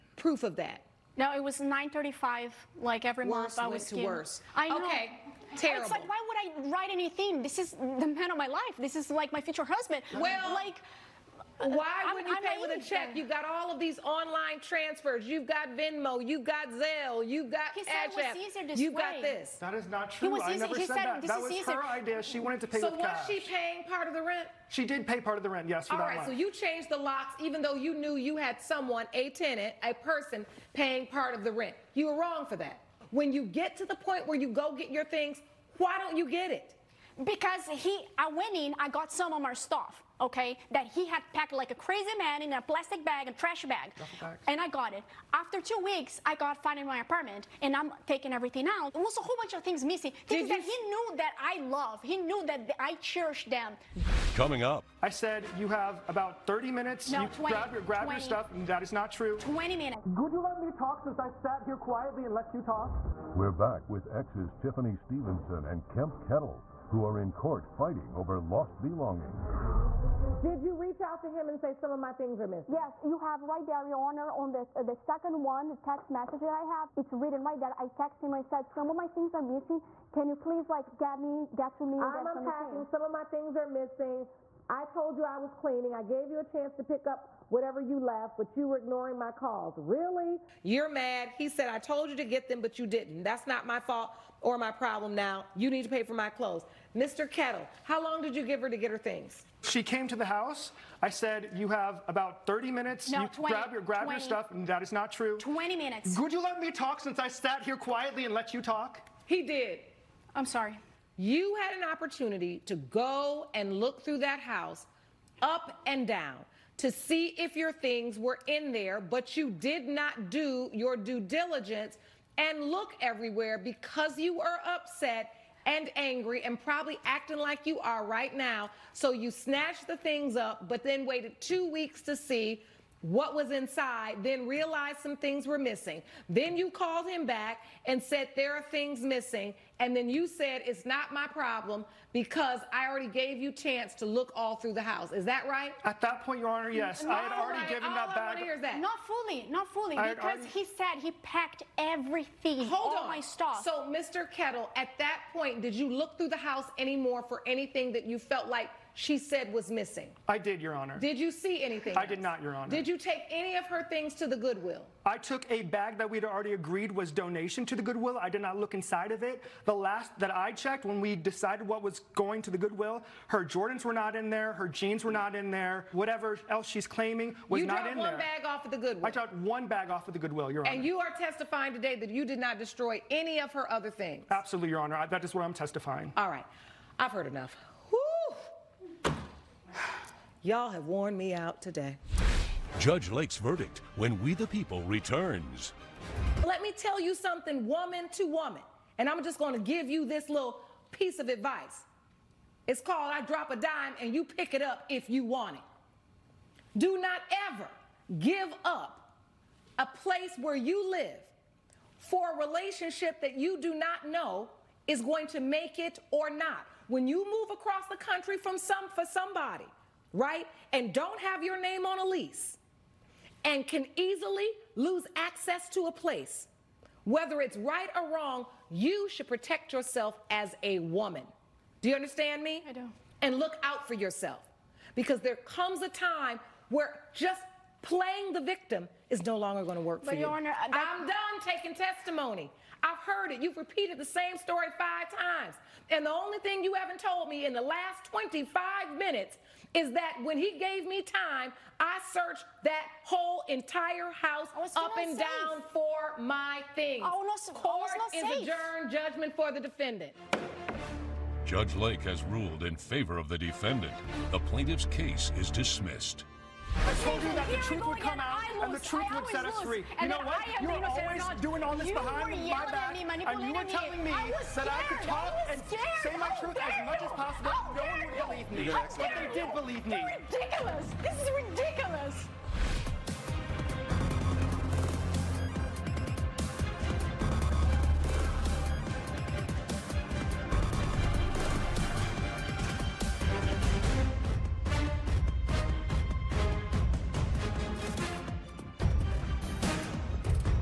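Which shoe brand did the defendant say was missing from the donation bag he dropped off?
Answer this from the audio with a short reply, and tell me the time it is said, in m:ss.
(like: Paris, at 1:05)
Jordans, at 2:53.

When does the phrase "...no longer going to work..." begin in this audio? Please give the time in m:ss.
3:59.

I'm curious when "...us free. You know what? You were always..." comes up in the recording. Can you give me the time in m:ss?
4:29.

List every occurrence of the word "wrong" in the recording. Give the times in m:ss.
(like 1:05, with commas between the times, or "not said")
0:32, 3:48.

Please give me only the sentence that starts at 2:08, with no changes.
So you snatched the things up, but then waited two weeks to see what was inside, then realized some things were missing.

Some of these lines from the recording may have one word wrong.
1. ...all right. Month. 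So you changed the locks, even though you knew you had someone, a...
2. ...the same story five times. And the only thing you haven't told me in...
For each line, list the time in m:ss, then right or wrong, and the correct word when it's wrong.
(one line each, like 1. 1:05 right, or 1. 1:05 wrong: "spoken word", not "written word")
1. 0:25 right
2. 4:03 right.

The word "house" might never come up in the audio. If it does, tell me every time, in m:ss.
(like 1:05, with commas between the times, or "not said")
1:40, 1:54, 2:24, 2:36, 4:14.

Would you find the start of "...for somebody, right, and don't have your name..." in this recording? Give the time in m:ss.
3:38.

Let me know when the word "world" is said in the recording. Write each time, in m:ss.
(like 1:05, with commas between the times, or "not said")
not said.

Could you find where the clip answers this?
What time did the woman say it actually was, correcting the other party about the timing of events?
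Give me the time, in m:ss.
0:01.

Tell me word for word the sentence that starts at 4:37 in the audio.
Oh, no one would believe me.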